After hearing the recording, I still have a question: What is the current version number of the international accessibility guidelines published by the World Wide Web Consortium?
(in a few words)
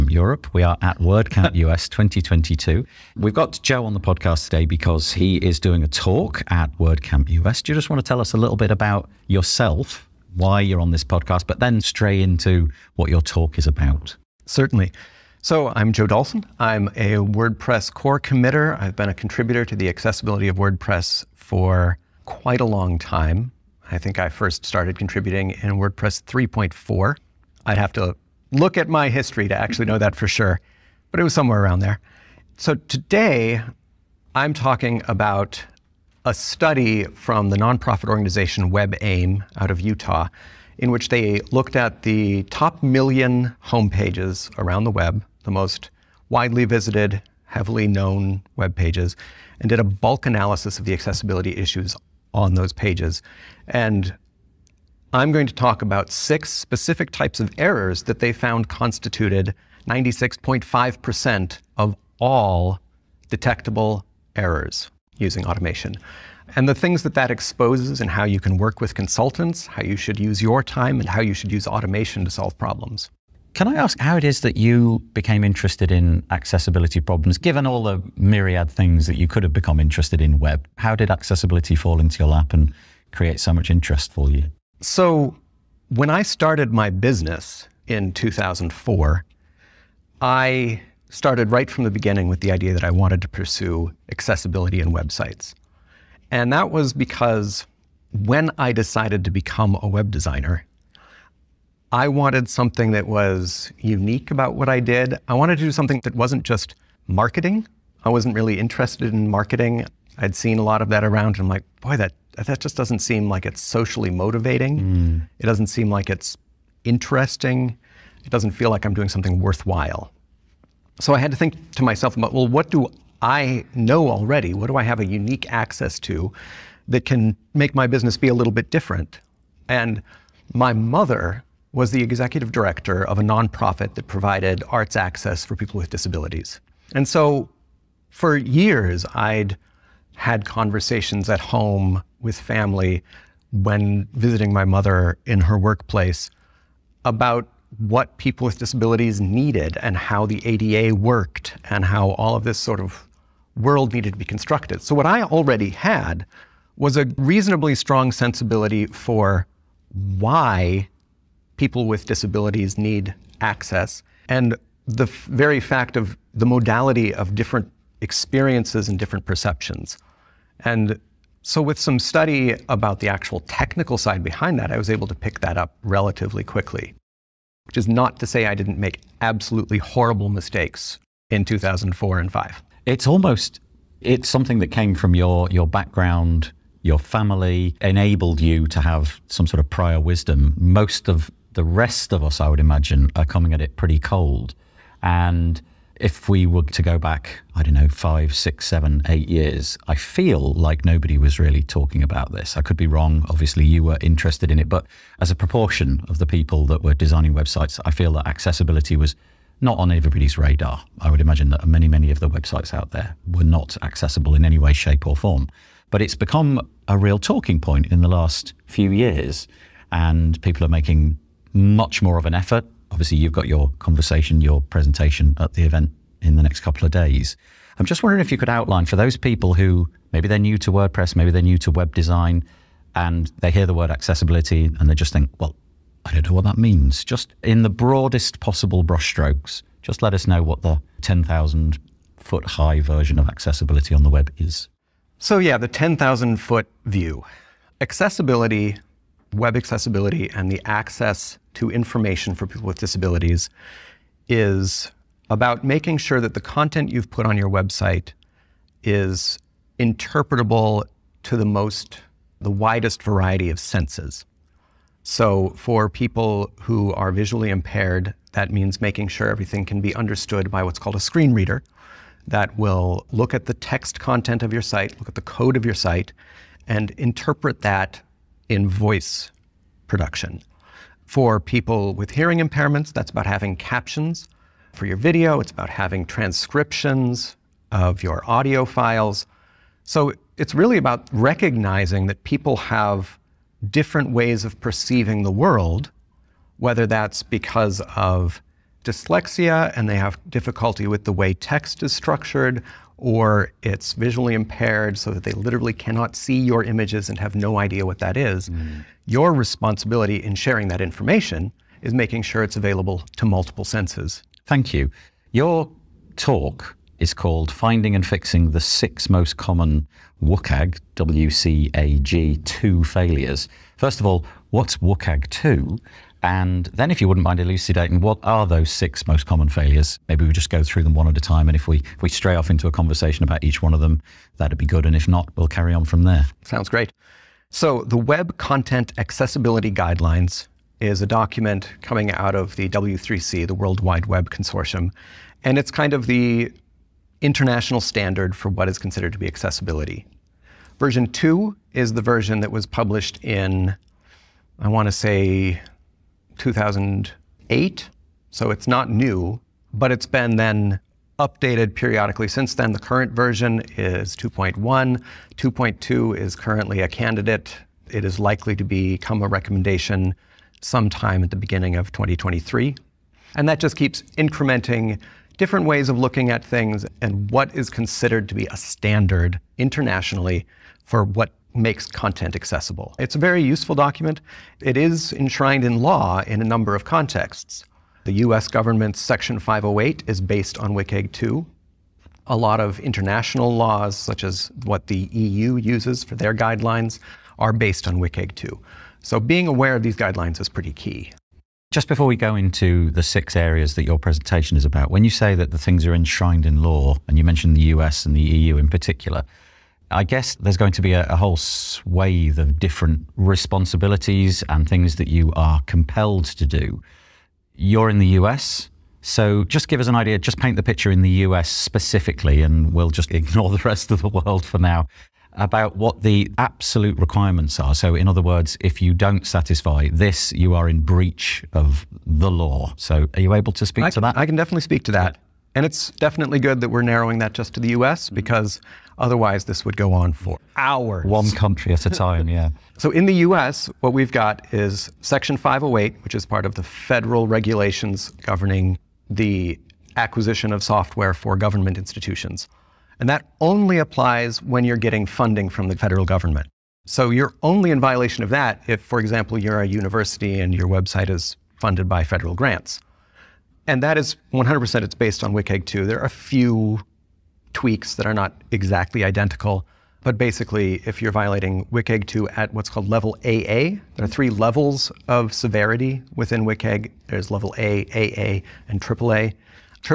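2.1.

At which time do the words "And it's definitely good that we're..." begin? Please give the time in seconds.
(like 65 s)
435 s.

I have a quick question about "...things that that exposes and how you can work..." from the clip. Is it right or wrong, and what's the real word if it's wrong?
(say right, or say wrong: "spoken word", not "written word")
right.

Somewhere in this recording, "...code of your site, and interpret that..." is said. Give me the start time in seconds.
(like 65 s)
275 s.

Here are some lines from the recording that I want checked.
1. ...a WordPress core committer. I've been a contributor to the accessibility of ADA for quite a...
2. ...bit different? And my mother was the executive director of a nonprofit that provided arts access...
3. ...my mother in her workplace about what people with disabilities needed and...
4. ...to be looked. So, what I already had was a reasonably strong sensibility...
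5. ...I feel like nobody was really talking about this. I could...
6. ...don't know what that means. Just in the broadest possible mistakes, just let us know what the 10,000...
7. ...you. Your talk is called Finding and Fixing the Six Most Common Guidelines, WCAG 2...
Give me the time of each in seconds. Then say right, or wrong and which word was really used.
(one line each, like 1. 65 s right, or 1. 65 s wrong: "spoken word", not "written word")
1. 16 s wrong: "WordPress", not "ADA"
2. 128 s right
3. 144 s right
4. 154 s wrong: "constructed", not "looked"
5. 199 s right
6. 236 s wrong: "brushstrokes", not "mistakes"
7. 314 s wrong: "WCAG", not "Guidelines".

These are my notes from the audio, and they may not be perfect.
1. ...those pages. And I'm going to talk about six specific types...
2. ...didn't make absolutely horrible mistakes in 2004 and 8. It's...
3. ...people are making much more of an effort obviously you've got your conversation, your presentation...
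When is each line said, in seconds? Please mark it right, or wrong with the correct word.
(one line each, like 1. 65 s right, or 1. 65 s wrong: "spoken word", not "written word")
1. 52 s right
2. 178 s wrong: "5", not "8"
3. 220 s right.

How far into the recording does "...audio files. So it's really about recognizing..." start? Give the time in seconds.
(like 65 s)
288 s.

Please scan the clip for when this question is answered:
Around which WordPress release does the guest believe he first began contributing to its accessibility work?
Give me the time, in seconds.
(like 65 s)
25 s.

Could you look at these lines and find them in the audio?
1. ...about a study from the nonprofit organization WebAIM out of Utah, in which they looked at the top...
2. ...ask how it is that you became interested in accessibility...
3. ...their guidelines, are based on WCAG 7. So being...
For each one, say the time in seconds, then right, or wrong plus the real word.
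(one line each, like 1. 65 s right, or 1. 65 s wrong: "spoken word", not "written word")
1. 35 s right
2. 73 s right
3. 396 s wrong: "2", not "7".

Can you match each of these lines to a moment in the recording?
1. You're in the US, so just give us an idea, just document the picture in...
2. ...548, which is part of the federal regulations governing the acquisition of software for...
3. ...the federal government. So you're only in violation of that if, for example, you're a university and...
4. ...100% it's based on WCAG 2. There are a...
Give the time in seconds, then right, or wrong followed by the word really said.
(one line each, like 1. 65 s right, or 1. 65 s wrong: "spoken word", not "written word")
1. 417 s wrong: "paint", not "document"
2. 445 s wrong: "508", not "548"
3. 455 s right
4. 464 s right.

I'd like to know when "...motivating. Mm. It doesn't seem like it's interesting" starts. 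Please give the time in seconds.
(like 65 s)
114 s.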